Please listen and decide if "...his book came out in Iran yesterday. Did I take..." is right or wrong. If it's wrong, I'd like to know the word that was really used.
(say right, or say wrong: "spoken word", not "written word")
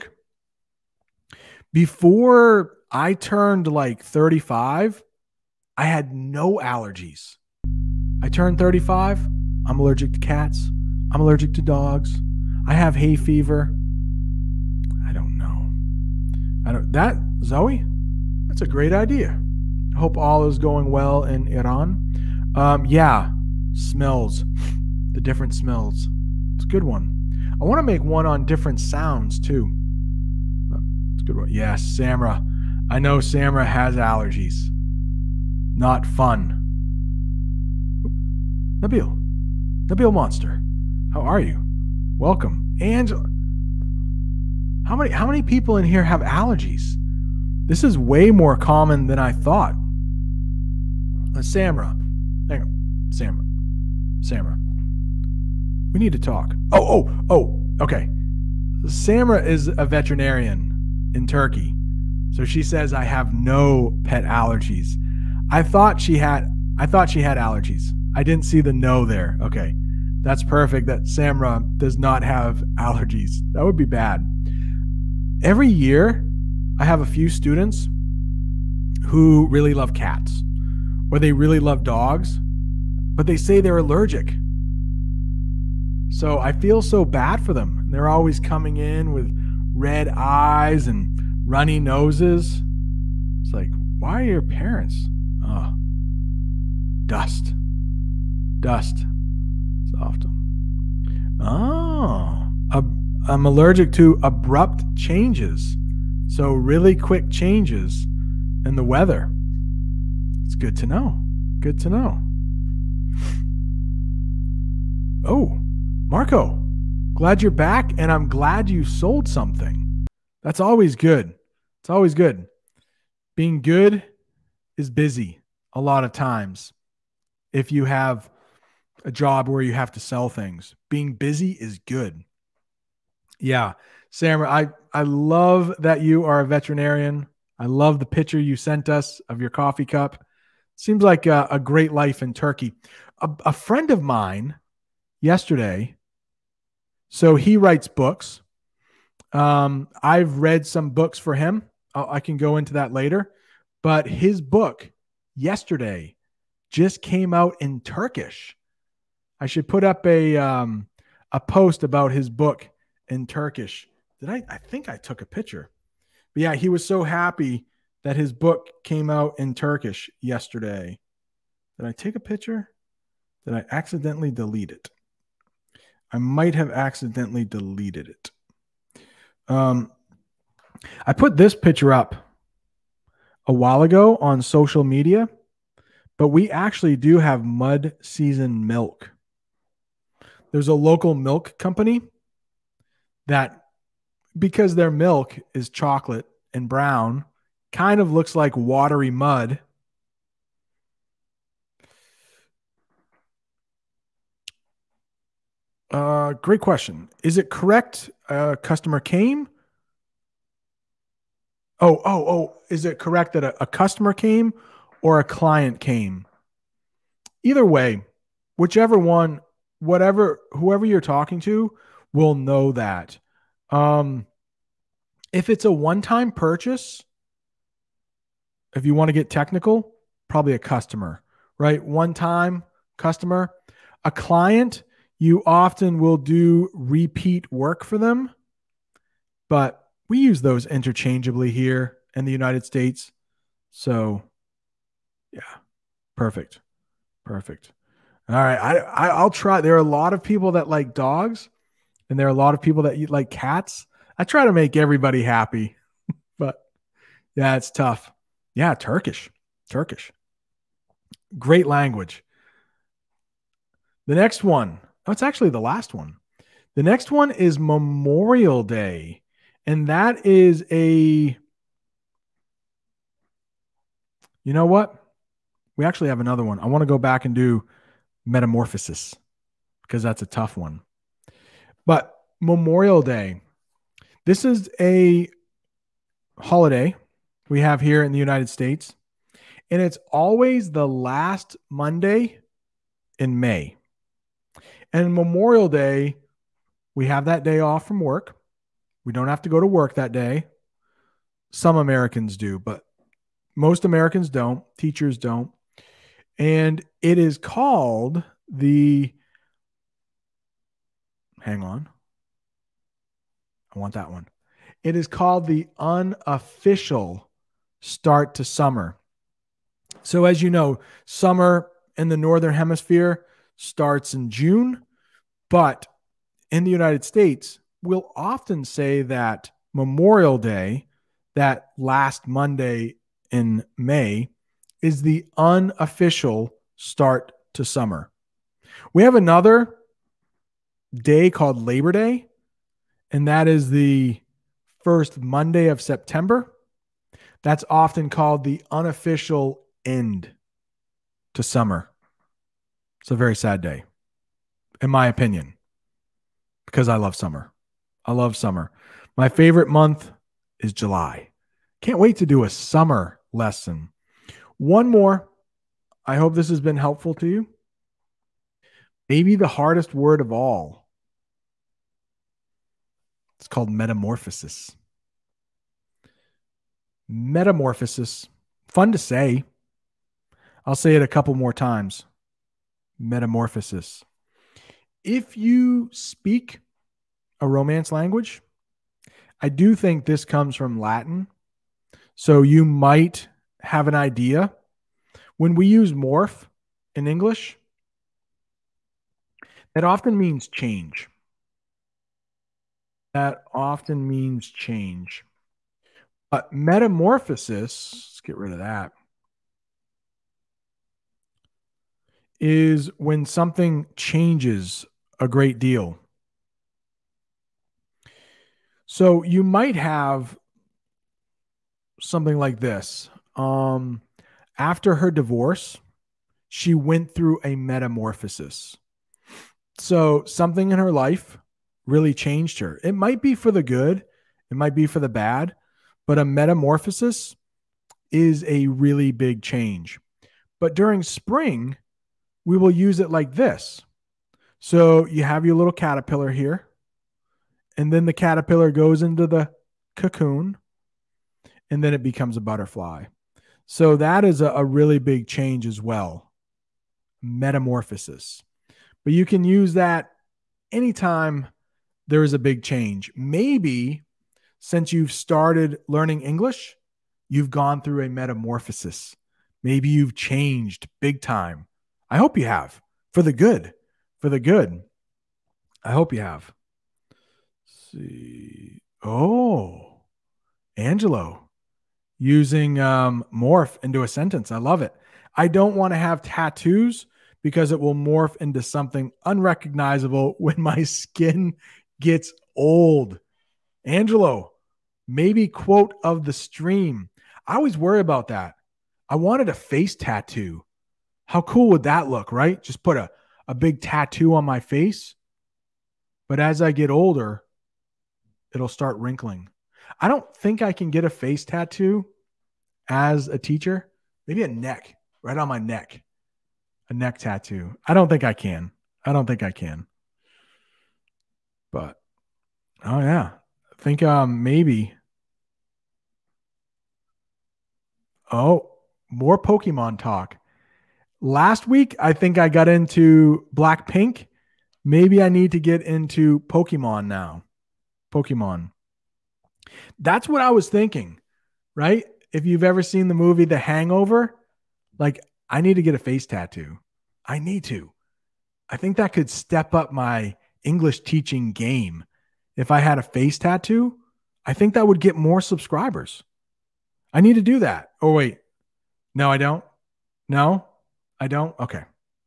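wrong: "Turkish", not "Iran".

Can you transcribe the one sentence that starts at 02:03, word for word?
Being good is busy a lot of times.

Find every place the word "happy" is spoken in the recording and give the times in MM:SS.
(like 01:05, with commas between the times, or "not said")
02:47, 04:15.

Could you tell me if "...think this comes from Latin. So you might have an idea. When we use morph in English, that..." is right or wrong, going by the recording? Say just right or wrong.
right.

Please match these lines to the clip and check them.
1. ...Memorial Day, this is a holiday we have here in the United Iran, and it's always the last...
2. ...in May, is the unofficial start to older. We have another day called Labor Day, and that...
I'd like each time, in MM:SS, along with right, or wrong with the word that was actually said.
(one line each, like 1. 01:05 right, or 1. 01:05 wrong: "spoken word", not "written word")
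1. 04:42 wrong: "States", not "Iran"
2. 05:33 wrong: "summer", not "older".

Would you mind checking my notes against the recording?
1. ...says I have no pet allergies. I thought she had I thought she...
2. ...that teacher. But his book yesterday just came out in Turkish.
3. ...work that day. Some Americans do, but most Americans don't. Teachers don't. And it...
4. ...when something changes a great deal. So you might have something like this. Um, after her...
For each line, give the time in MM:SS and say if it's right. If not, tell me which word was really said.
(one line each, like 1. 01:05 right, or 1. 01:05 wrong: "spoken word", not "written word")
1. 01:02 right
2. 02:32 wrong: "later", not "teacher"
3. 04:59 right
4. 06:52 right.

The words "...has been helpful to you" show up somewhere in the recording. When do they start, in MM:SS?
06:06.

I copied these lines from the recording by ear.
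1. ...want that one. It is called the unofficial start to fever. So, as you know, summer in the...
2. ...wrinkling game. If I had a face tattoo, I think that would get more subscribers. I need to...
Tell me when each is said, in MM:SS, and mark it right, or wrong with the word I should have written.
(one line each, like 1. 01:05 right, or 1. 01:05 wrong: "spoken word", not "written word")
1. 05:13 wrong: "summer", not "fever"
2. 09:11 wrong: "teaching", not "wrinkling".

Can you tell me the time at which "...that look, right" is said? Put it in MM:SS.
08:21.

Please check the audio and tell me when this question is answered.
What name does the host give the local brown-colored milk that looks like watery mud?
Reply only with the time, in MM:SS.
03:07.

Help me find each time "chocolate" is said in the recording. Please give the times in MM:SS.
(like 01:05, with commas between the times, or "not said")
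03:15.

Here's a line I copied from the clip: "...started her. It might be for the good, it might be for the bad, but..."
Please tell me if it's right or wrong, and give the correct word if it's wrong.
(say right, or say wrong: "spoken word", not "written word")
wrong: "changed", not "started".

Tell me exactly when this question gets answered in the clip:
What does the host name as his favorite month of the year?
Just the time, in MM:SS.
06:00.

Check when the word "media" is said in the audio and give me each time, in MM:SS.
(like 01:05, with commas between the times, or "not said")
03:04.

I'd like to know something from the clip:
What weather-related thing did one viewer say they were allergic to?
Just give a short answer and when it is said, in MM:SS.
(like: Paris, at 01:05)
abrupt changes, at 01:44.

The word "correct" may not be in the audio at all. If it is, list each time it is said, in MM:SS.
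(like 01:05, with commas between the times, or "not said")
03:27, 03:32.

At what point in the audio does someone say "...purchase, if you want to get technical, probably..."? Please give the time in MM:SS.
03:46.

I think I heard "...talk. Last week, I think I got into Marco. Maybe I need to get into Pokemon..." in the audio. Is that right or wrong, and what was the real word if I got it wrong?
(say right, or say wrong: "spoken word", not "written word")
wrong: "Blackpink", not "Marco".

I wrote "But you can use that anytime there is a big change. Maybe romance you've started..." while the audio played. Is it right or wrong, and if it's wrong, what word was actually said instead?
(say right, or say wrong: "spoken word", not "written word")
wrong: "since", not "romance".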